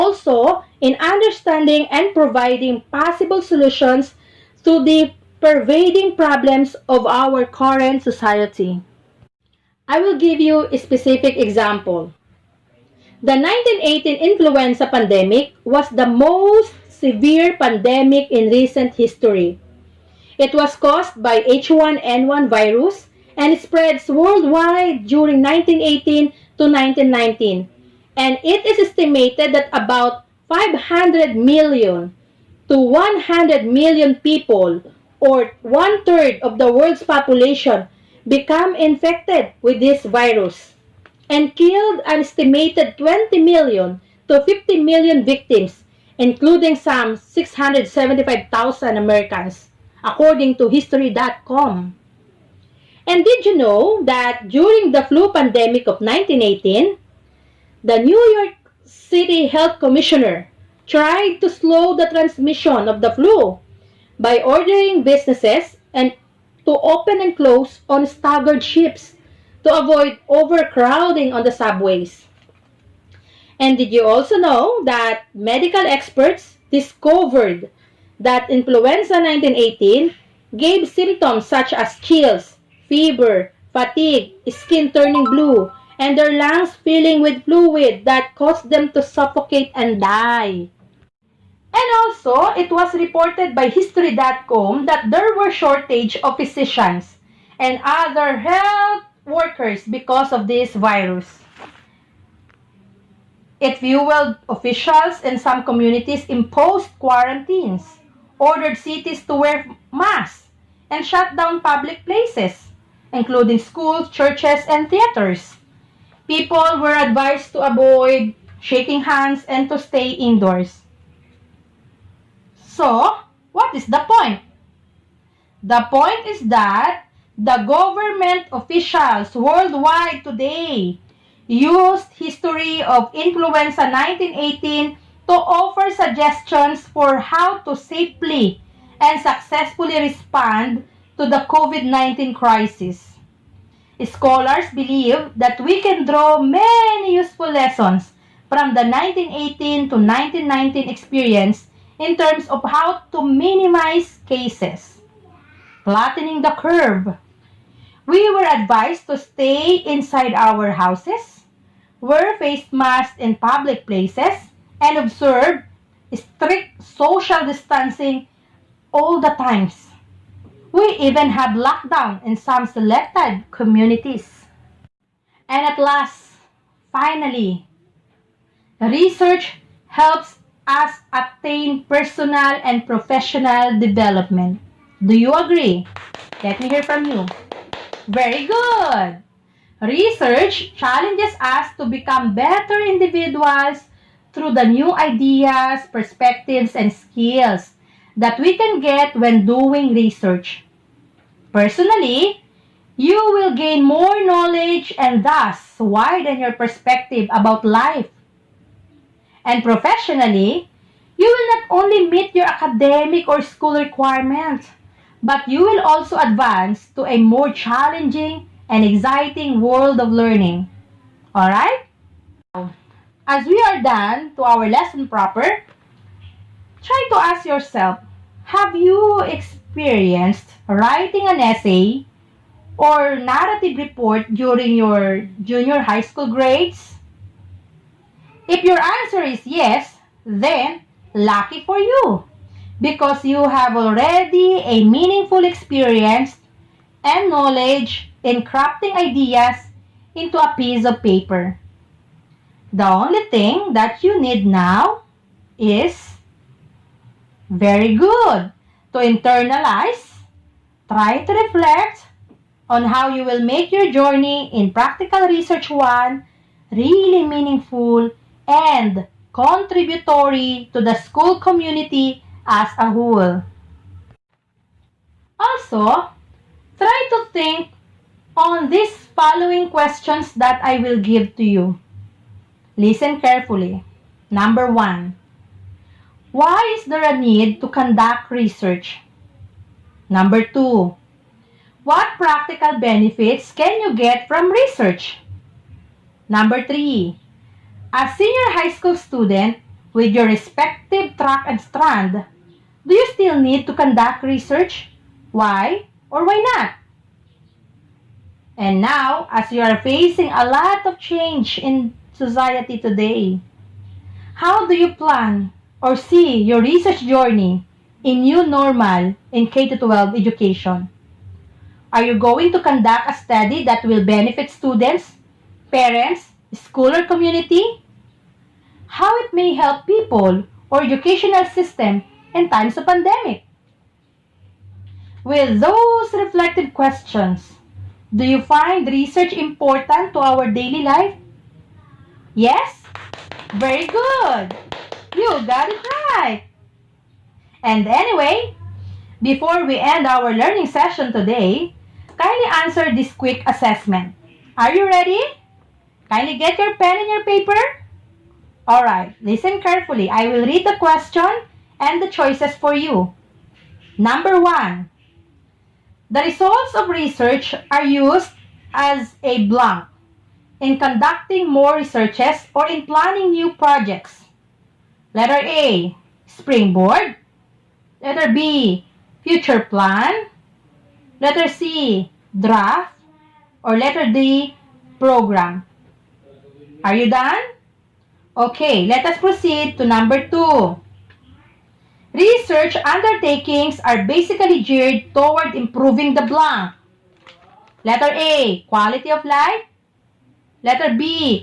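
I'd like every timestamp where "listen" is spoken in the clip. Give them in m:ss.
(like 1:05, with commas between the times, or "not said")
4:42, 5:59.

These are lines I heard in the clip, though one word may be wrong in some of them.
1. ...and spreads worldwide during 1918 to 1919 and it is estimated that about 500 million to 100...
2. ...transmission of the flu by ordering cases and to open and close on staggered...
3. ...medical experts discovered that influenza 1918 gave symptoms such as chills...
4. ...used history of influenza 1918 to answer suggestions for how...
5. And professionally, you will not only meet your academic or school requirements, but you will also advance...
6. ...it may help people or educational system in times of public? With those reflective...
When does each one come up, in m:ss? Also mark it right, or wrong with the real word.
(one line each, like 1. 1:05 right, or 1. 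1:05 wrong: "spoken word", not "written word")
1. 0:23 right
2. 1:02 wrong: "businesses", not "cases"
3. 1:15 right
4. 2:11 wrong: "offer", not "answer"
5. 3:29 right
6. 5:29 wrong: "pandemic", not "public".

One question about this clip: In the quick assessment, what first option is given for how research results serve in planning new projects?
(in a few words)
springboard.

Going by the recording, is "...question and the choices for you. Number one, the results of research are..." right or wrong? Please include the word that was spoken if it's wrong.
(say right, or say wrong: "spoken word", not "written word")
right.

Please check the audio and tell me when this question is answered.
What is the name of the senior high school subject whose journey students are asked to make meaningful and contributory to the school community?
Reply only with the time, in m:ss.
4:24.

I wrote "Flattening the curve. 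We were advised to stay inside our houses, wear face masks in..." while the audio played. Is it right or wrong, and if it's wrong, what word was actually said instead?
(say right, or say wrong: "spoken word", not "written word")
right.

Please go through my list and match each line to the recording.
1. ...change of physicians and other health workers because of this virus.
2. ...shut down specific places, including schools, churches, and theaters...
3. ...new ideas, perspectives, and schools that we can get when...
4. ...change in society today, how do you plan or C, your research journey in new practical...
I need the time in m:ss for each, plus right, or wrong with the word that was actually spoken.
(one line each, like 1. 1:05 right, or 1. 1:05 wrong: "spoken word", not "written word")
1. 1:35 wrong: "shortage", not "change"
2. 1:51 wrong: "public", not "specific"
3. 3:14 wrong: "skills", not "schools"
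4. 5:10 wrong: "normal", not "practical".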